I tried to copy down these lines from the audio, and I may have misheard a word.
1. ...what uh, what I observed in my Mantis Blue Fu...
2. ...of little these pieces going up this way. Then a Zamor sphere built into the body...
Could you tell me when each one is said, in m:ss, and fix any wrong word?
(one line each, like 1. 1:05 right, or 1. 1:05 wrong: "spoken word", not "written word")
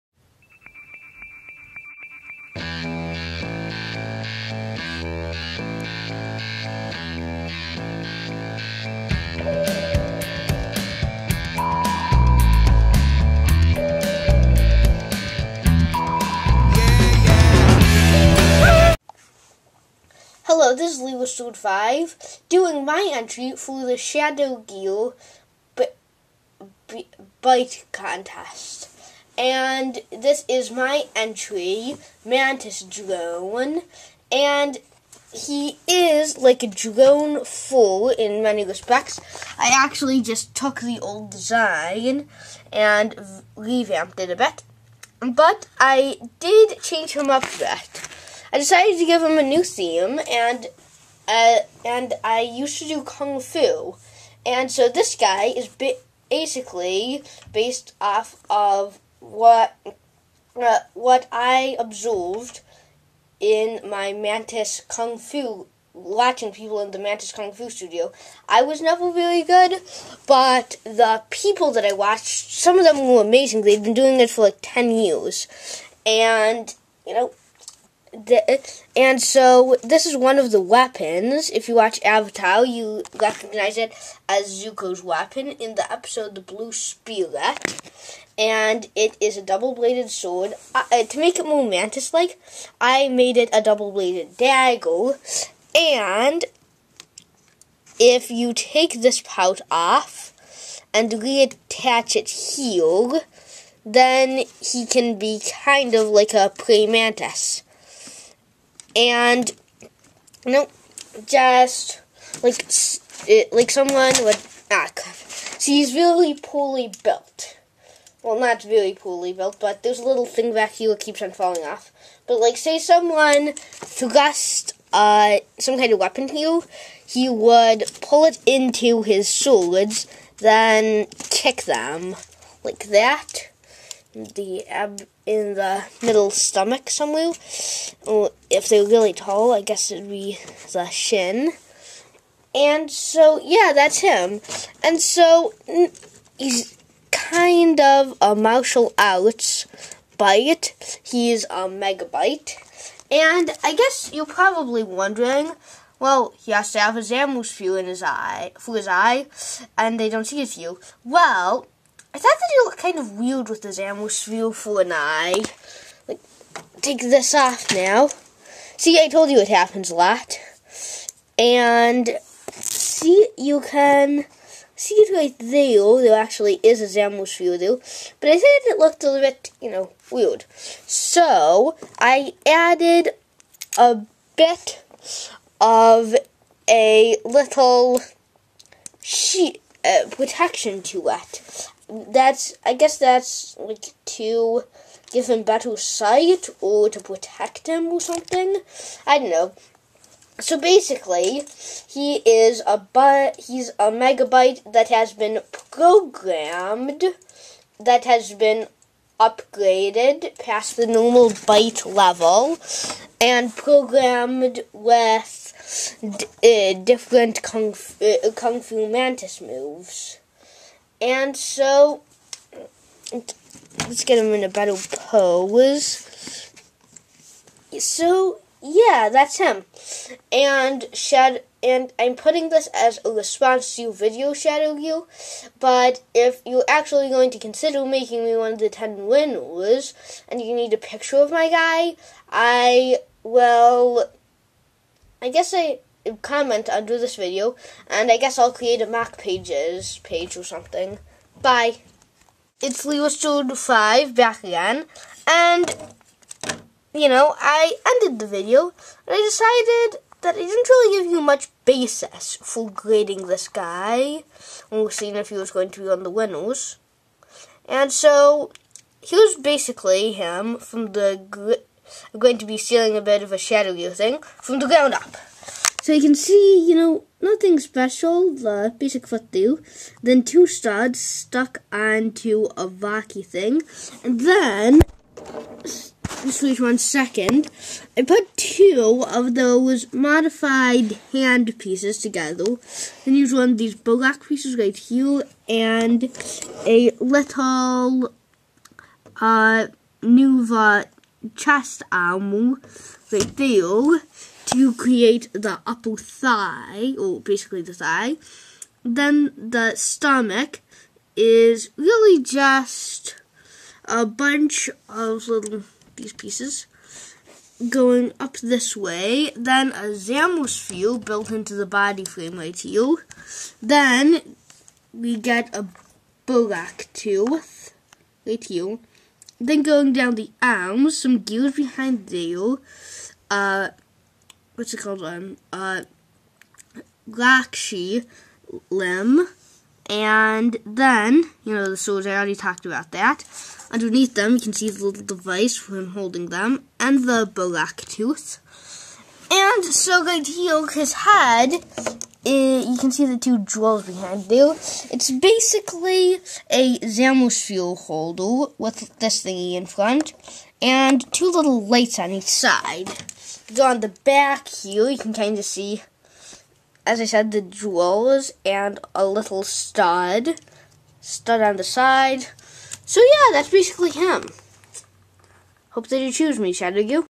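1. 0:59 wrong: "Kung", not "Blue"
2. 5:14 right.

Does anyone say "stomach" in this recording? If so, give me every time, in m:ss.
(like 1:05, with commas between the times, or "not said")
2:16, 5:09.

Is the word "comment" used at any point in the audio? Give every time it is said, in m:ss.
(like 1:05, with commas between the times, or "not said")
4:06.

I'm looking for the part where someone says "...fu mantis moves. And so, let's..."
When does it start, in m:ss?
3:38.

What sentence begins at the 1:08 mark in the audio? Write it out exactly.
I was never really good, but the people that I watched, some of them were amazing.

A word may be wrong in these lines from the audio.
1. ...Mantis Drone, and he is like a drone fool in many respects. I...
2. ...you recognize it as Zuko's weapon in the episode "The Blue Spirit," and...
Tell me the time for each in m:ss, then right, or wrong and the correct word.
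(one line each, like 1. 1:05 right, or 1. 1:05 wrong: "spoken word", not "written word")
1. 0:32 right
2. 1:22 right.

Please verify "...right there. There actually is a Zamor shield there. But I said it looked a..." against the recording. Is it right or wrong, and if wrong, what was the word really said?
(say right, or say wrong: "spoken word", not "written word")
right.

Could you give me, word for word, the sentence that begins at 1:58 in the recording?
Well, not really poorly built, but there's a little thing back here that keeps on falling off.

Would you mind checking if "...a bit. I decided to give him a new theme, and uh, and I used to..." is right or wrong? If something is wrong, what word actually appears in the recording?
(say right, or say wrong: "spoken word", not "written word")
right.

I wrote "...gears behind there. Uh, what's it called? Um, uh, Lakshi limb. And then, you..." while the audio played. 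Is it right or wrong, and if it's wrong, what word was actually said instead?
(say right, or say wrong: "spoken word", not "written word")
right.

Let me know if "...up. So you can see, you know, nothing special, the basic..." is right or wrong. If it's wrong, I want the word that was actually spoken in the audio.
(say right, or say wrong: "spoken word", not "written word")
right.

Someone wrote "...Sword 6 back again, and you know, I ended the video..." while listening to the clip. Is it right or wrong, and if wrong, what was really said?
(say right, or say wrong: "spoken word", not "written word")
wrong: "5", not "6".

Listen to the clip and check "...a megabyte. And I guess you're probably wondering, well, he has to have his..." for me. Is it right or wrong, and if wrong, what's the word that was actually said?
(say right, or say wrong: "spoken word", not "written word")
right.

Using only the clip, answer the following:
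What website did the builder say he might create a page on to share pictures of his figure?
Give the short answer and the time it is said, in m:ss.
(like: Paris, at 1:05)
MOCpages, at 4:08.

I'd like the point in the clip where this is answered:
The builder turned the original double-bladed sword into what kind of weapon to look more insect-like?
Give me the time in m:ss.
1:33.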